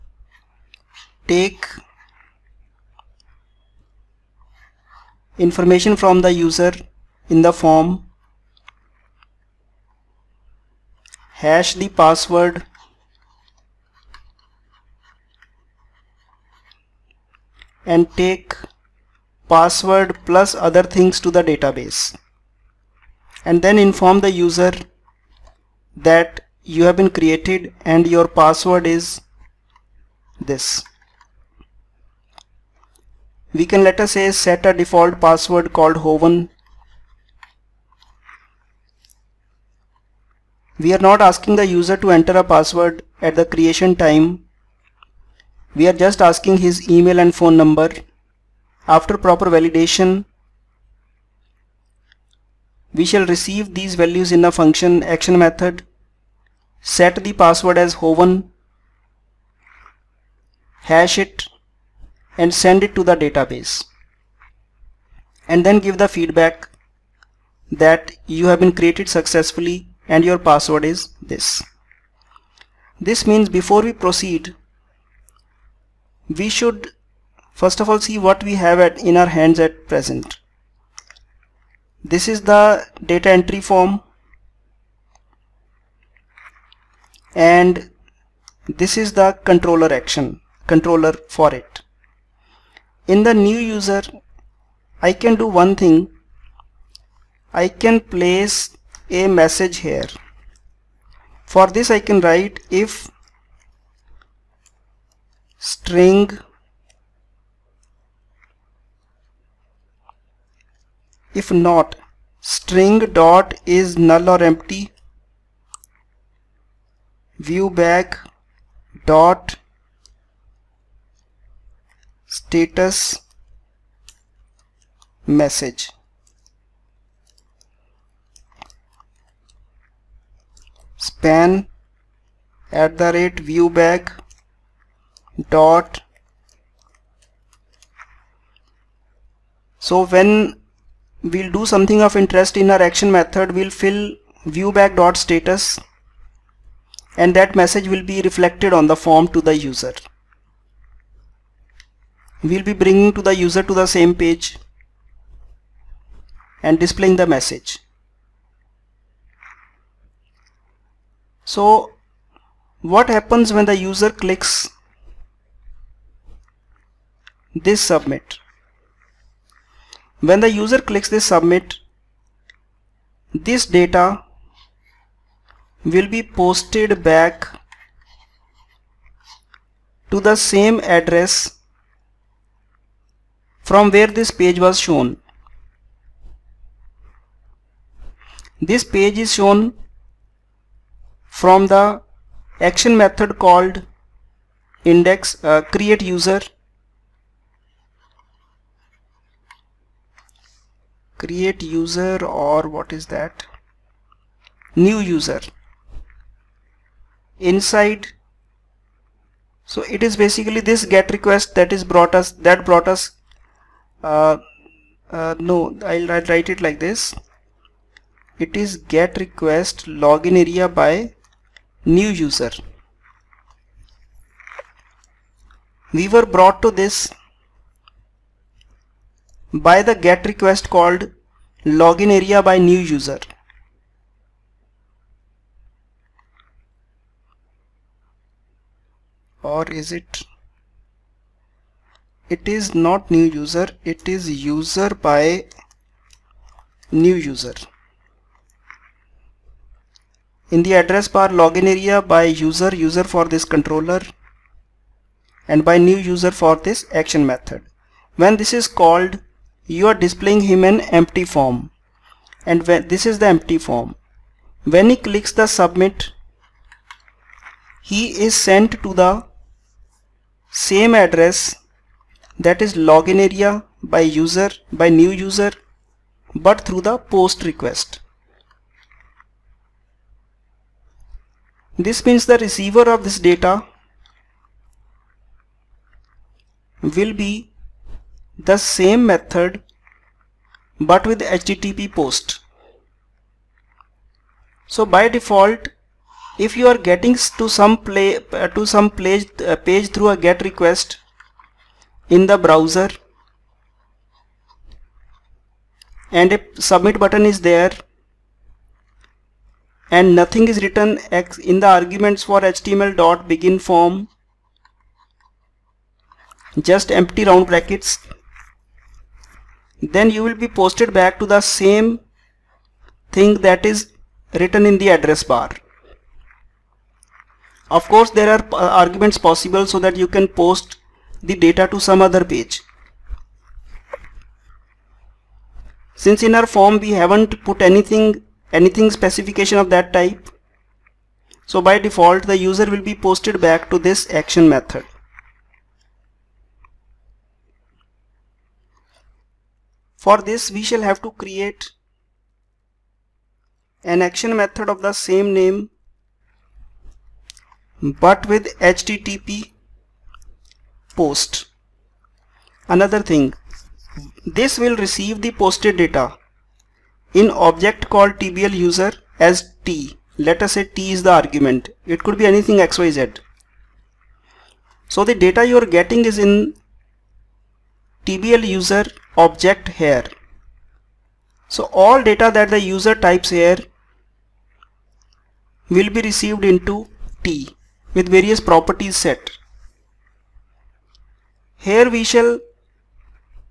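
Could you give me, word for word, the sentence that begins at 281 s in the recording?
This means the receiver of this data will be the same method but with HTTP post.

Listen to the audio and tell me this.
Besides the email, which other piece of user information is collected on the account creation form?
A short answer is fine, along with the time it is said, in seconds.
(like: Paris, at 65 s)
phone number, at 47 s.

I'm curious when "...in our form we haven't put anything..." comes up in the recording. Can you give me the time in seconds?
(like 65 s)
336 s.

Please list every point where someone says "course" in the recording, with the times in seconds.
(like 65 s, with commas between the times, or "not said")
327 s.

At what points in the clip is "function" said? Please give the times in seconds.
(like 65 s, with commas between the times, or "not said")
54 s.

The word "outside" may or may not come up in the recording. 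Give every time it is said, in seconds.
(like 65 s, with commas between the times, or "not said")
not said.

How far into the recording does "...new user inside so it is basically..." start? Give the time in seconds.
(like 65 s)
204 s.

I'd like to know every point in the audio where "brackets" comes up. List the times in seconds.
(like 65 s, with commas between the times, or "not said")
317 s.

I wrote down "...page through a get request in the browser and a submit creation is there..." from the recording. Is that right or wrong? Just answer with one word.
wrong.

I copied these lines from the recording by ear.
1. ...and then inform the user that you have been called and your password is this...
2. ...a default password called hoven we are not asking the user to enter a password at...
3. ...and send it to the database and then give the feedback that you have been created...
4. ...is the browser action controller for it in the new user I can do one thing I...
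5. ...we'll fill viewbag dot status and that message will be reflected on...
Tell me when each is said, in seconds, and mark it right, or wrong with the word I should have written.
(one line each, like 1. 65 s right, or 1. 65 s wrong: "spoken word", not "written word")
1. 23 s wrong: "created", not "called"
2. 34 s right
3. 62 s right
4. 88 s wrong: "controller", not "browser"
5. 143 s right.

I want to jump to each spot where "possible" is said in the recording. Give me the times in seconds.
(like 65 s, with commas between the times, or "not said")
329 s.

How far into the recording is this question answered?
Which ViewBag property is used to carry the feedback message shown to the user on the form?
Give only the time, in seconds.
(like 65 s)
122 s.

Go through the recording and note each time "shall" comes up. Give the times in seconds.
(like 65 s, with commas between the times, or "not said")
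53 s, 350 s, 392 s.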